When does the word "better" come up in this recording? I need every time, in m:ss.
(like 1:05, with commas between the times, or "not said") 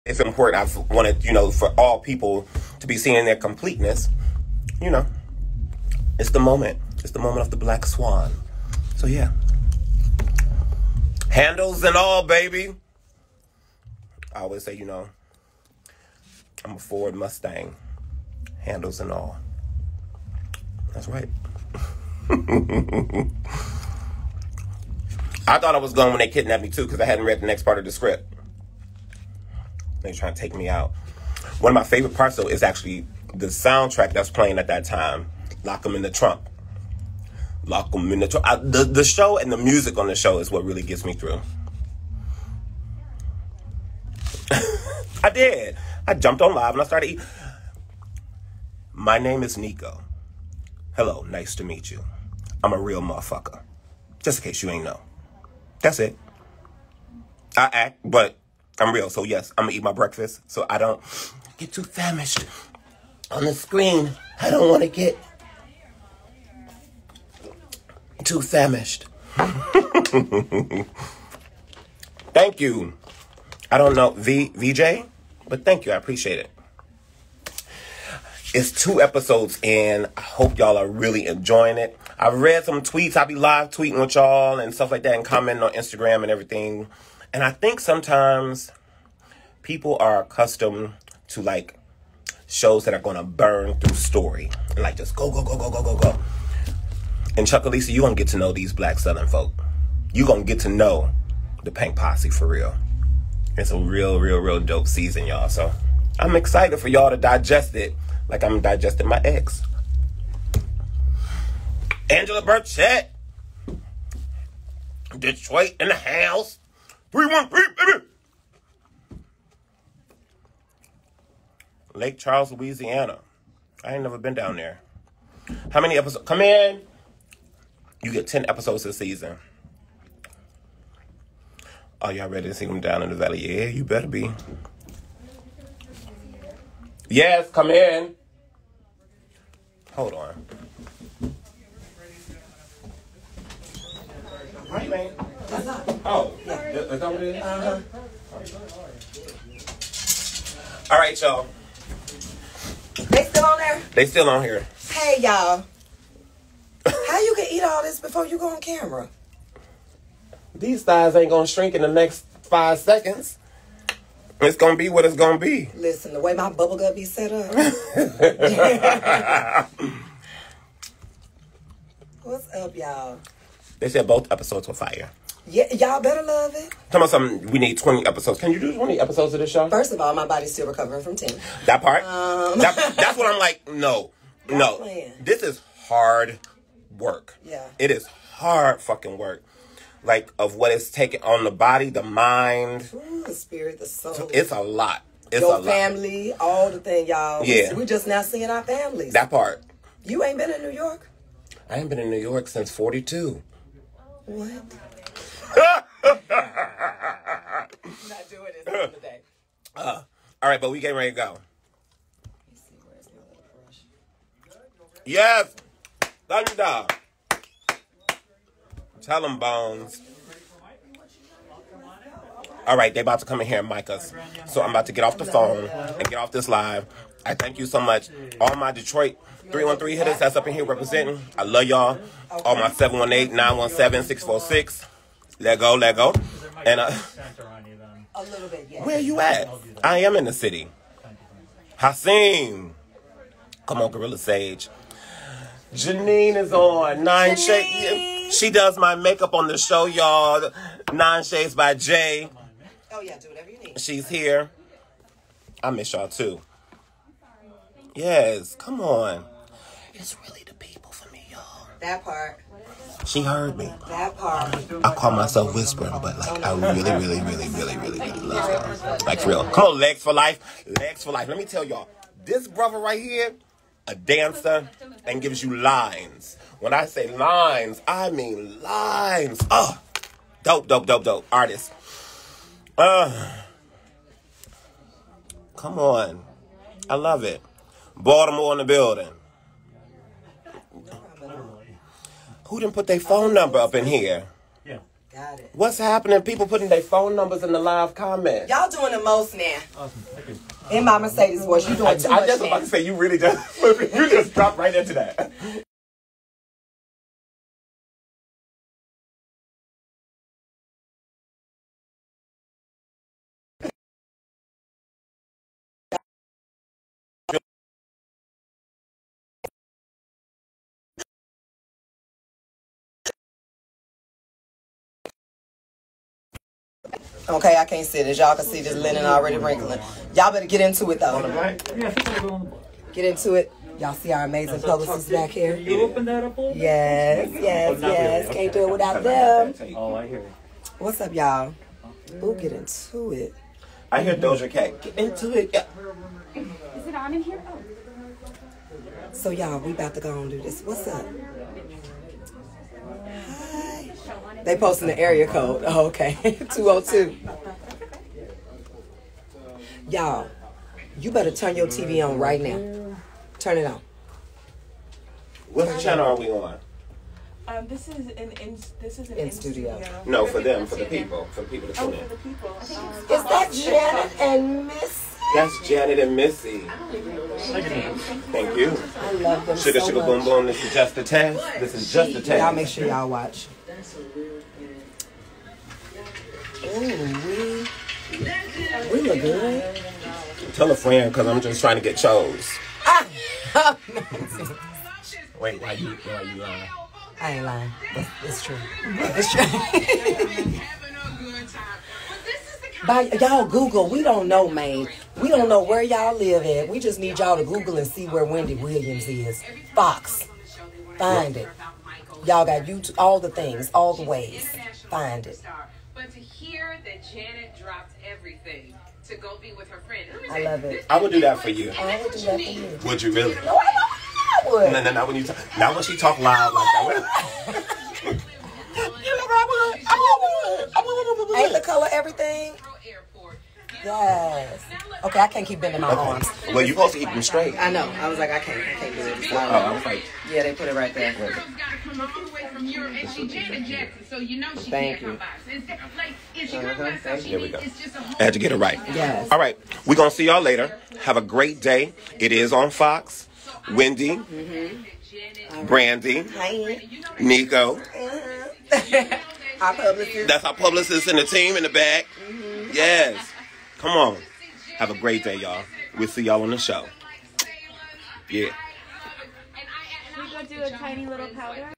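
2:13, 2:56, 5:30, 6:01.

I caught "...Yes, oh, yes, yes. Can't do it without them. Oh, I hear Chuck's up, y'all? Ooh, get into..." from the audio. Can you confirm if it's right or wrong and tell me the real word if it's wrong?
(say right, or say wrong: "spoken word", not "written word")
wrong: "What", not "Chuck".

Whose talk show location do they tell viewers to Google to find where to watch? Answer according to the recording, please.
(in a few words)
Wendy Williams.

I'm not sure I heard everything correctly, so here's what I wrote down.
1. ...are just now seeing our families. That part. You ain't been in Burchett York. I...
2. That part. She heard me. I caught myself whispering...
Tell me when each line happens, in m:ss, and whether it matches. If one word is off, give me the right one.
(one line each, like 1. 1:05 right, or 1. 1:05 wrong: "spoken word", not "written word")
1. 3:17 wrong: "New", not "Burchett"
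2. 4:21 right.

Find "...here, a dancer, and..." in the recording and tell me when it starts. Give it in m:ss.
4:33.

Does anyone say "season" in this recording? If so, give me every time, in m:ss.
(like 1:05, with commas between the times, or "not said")
1:44, 2:08.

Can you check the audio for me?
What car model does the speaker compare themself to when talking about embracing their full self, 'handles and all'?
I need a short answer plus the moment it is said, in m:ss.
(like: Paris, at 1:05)
Ford Mustang, at 0:16.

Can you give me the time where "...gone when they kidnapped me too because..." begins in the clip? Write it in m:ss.
0:25.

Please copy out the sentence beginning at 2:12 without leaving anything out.
Are y'all ready to see them down in the valley?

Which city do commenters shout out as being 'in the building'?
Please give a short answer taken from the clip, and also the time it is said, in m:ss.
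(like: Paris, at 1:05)
Baltimore, at 4:47.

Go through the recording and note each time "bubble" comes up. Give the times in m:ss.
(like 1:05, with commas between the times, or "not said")
2:46.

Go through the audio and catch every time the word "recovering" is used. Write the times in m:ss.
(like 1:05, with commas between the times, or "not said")
3:00.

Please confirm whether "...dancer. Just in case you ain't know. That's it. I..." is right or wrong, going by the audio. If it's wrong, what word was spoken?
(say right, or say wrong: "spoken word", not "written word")
wrong: "motherfucker", not "dancer".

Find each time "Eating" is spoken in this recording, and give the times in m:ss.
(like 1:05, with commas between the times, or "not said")
0:47.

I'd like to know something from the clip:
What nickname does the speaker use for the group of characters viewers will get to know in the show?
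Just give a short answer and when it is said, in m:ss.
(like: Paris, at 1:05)
Pink Posse, at 1:41.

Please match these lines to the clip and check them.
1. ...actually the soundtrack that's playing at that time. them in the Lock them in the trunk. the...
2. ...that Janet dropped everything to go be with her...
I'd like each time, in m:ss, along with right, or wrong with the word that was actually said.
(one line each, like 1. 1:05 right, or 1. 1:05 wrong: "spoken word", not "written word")
1. 0:32 right
2. 6:56 right.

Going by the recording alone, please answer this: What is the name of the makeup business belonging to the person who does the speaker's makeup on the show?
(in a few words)
Nine Shades by Jay.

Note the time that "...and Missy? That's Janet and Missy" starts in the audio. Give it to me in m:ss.
6:14.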